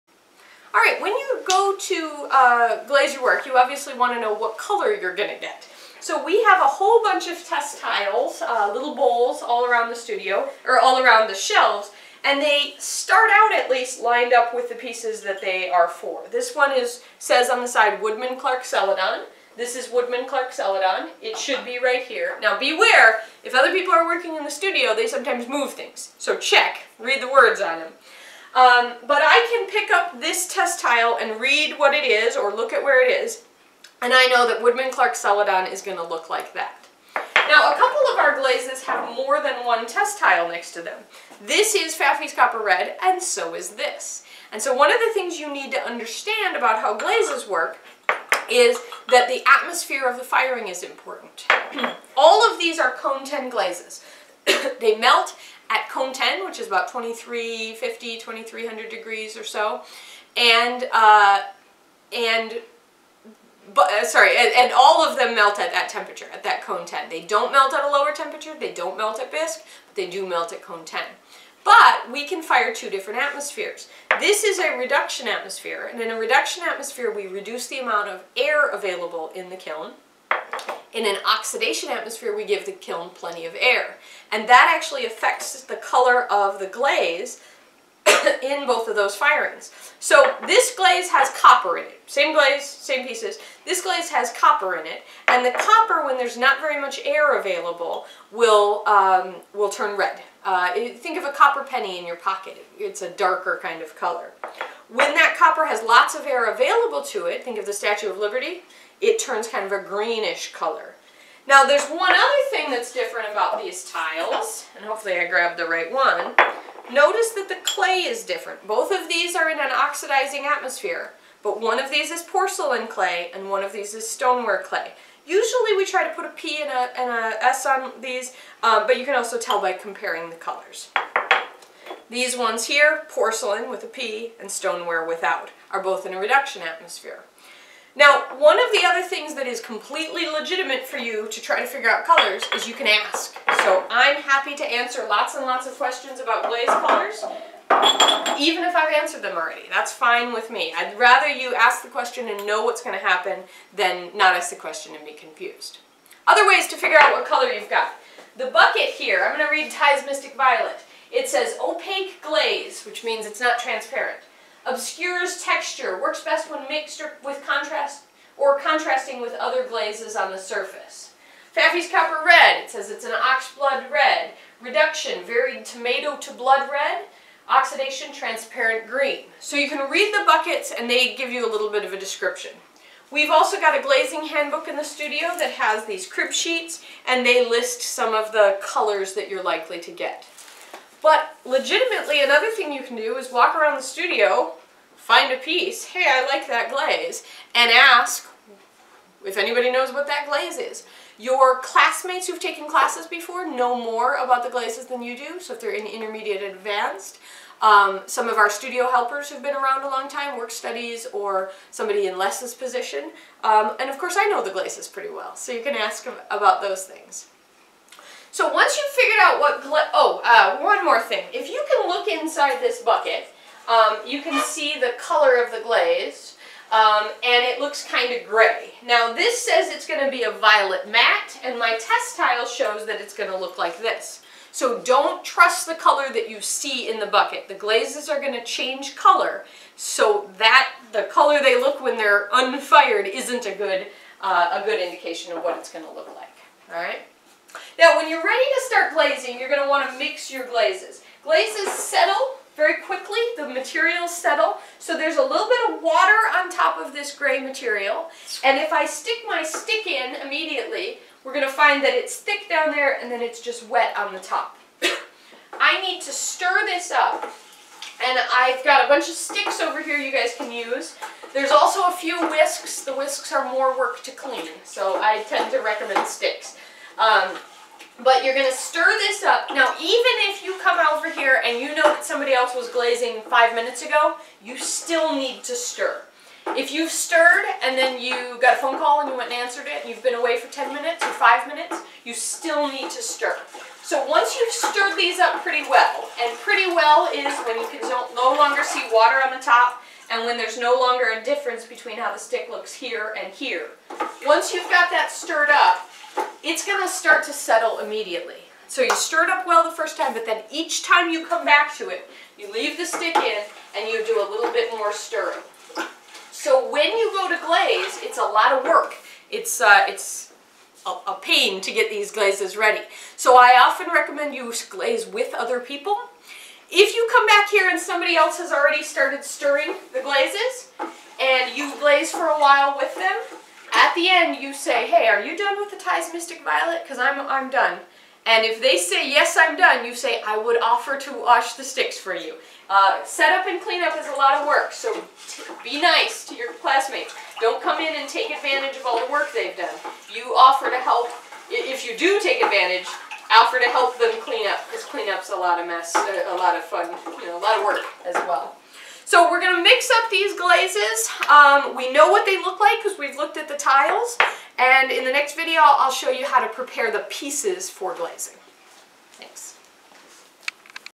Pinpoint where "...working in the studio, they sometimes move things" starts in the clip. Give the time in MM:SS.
00:24.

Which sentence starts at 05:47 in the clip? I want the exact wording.
Don't come in and take advantage of all the work they've done.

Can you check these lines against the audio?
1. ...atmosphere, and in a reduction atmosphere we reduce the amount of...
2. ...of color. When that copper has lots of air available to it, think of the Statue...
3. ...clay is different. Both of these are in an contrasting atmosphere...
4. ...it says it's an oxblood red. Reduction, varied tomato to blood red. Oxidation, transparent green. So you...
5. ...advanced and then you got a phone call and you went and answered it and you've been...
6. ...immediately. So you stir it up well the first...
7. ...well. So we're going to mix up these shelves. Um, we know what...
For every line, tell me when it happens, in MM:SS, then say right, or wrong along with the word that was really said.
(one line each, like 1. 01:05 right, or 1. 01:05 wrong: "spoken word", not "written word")
1. 01:15 right
2. 01:43 right
3. 01:57 wrong: "oxidizing", not "contrasting"
4. 02:52 right
5. 04:46 wrong: "stirred", not "advanced"
6. 05:07 right
7. 05:58 wrong: "glazes", not "shelves".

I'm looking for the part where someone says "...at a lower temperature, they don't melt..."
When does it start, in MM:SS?
01:07.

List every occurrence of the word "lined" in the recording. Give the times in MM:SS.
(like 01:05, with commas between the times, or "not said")
00:14.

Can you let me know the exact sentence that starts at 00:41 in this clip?
This is Faffy's Copper Red, and so is this.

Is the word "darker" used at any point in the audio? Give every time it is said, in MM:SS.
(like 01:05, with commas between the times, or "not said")
01:43.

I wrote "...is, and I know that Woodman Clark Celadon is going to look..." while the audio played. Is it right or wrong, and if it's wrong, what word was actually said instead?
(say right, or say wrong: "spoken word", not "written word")
right.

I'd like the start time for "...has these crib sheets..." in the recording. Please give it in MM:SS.
03:05.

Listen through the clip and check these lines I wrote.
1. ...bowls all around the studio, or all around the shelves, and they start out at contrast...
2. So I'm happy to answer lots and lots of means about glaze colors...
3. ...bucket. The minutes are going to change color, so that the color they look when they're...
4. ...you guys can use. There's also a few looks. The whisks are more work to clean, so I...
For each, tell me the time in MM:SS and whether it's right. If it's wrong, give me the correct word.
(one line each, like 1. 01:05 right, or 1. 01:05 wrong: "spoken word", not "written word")
1. 00:08 wrong: "least", not "contrast"
2. 02:23 wrong: "questions", not "means"
3. 03:57 wrong: "glazes", not "minutes"
4. 04:29 wrong: "whisks", not "looks".